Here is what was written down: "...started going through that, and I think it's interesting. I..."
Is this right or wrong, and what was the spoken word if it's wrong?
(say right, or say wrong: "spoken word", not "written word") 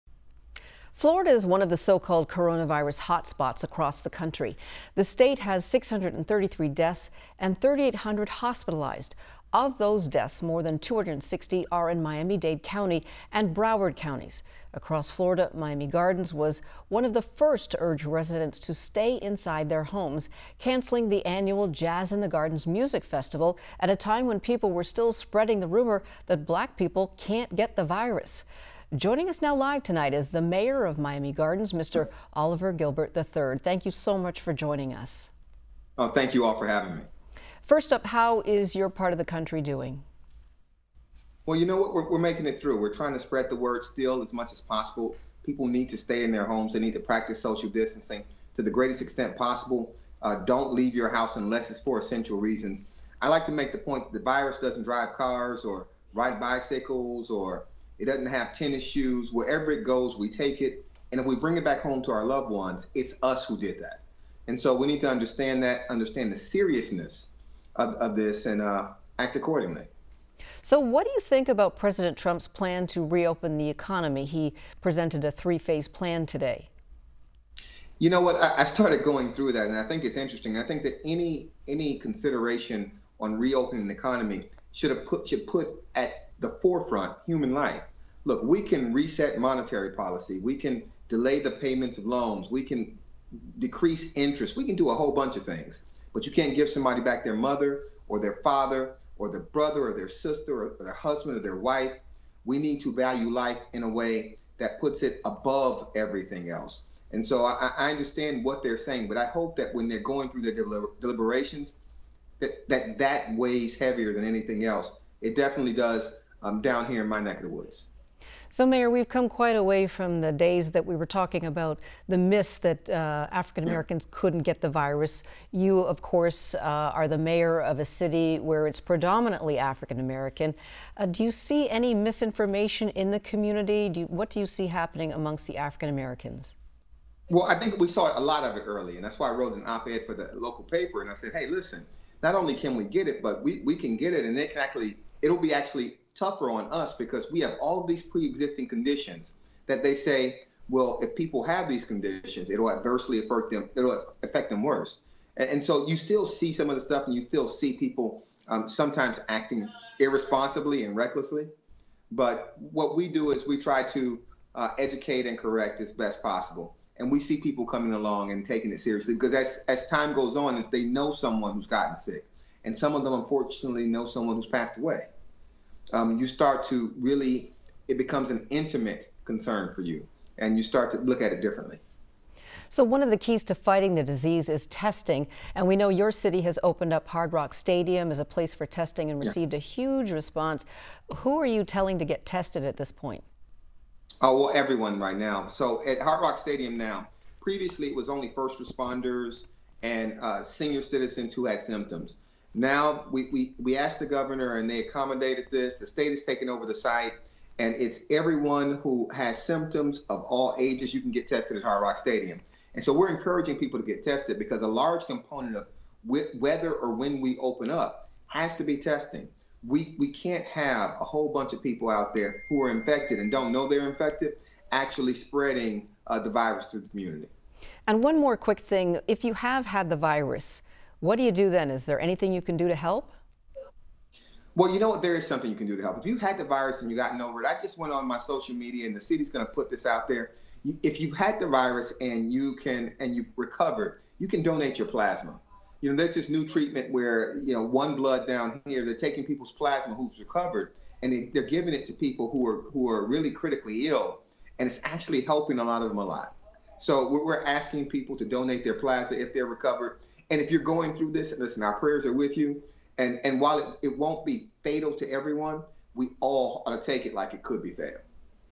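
right.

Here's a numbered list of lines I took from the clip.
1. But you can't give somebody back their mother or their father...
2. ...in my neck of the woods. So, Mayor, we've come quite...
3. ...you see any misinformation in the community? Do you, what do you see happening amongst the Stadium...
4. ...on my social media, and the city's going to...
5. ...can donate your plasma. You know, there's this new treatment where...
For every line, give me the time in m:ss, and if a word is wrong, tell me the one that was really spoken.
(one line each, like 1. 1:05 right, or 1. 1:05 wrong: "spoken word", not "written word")
1. 1:36 right
2. 1:57 right
3. 2:11 wrong: "African", not "Stadium"
4. 3:57 right
5. 4:04 right.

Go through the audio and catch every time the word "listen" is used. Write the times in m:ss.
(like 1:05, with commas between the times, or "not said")
2:21, 4:21.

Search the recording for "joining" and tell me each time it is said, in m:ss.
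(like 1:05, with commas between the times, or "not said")
0:28, 0:34.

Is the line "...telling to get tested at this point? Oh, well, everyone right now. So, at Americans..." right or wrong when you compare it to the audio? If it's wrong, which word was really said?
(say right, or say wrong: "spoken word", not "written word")
wrong: "Hard", not "Americans".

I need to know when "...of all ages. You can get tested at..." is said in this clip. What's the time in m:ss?
3:30.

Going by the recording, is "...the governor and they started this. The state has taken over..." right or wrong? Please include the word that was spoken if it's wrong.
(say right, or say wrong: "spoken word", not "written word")
wrong: "accommodated", not "started".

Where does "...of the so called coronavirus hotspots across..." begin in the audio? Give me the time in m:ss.
0:01.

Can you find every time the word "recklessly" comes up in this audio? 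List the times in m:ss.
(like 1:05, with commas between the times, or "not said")
2:40.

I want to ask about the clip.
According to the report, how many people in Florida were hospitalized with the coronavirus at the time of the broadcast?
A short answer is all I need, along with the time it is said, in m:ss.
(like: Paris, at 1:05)
3,800, at 0:07.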